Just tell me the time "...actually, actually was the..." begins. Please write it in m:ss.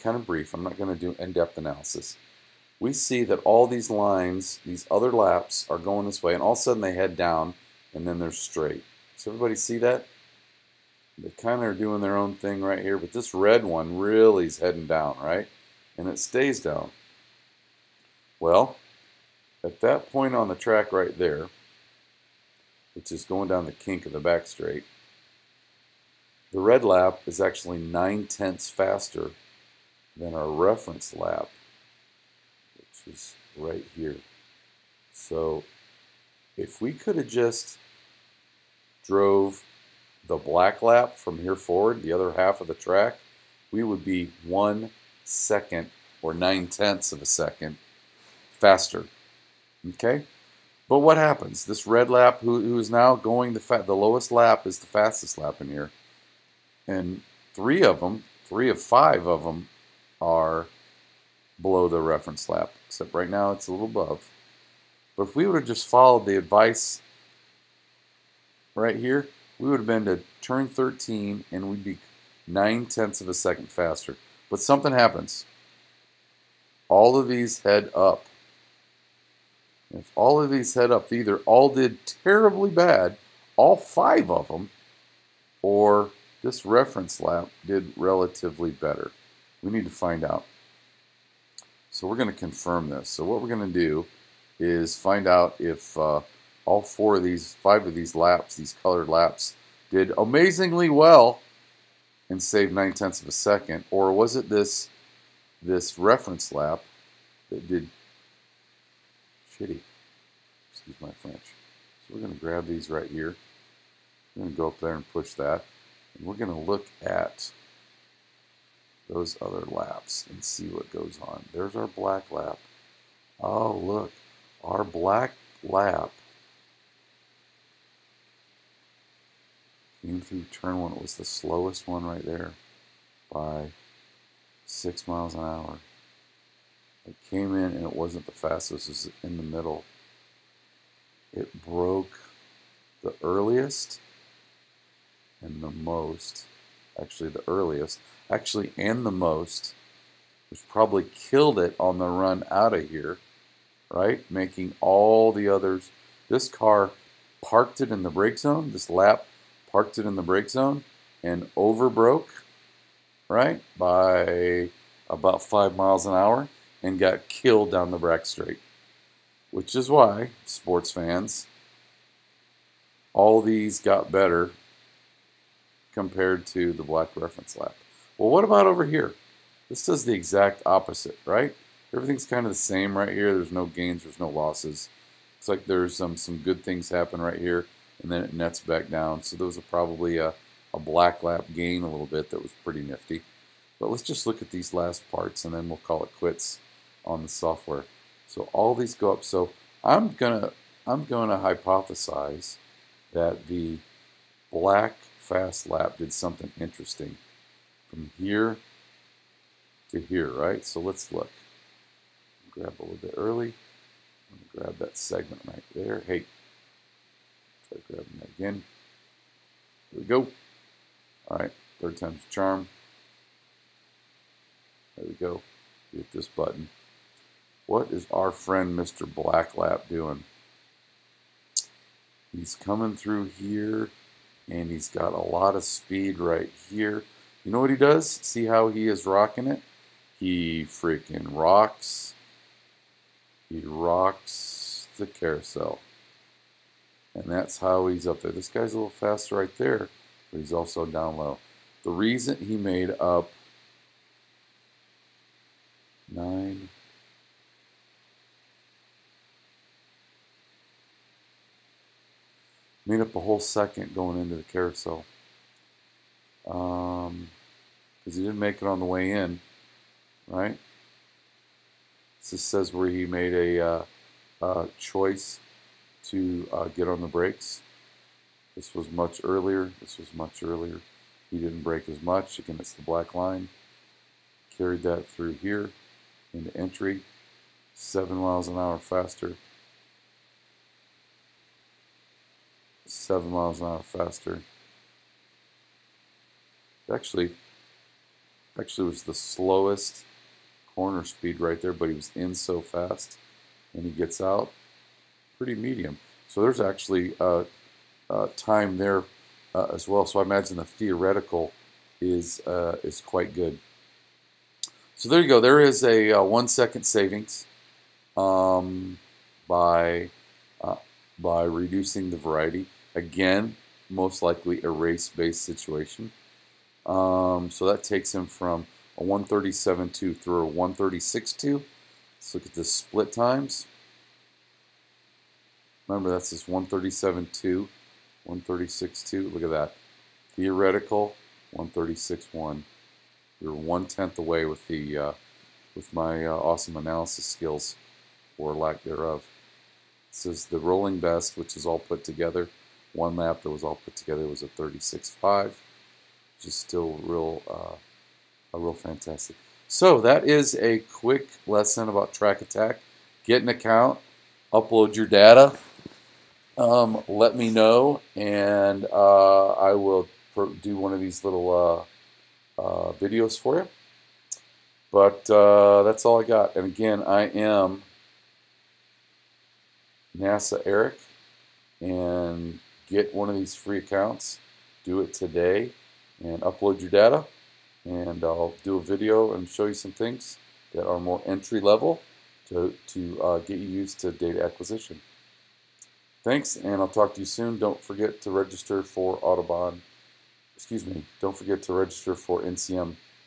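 4:56.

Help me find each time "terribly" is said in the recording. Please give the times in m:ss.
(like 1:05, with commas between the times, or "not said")
1:22.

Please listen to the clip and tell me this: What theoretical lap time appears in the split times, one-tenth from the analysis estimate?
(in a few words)
136.1.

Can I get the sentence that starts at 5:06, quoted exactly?
So there's actually a time there uh, as well.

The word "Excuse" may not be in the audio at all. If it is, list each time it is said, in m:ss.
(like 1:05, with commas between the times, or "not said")
1:50, 6:40.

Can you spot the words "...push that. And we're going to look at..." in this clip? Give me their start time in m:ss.
1:55.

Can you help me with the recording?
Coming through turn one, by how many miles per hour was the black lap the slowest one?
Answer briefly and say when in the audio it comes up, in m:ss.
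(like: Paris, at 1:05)
6 mph, at 2:14.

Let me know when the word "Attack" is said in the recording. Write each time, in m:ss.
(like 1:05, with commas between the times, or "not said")
6:02.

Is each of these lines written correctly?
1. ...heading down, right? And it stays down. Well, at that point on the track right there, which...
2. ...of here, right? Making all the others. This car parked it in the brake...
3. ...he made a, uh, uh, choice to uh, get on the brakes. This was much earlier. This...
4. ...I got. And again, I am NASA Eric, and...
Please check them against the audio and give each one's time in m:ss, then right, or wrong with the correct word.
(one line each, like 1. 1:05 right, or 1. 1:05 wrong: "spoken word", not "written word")
1. 0:14 right
2. 2:32 right
3. 4:32 right
4. 6:16 right.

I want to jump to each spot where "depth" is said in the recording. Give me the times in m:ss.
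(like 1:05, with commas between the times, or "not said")
0:01.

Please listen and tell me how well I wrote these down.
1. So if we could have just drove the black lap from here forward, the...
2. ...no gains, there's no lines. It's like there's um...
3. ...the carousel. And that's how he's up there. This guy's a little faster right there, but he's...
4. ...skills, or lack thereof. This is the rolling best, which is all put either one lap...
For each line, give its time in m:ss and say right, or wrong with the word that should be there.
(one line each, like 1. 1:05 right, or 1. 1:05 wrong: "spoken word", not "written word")
1. 0:35 right
2. 3:03 wrong: "losses", not "lines"
3. 4:04 right
4. 5:47 wrong: "together", not "either".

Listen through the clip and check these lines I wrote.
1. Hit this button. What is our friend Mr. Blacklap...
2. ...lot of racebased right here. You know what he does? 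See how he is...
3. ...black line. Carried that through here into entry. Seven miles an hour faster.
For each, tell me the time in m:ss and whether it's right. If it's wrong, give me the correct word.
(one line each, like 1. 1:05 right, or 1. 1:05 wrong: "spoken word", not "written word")
1. 3:45 right
2. 3:55 wrong: "speed", not "racebased"
3. 4:42 right.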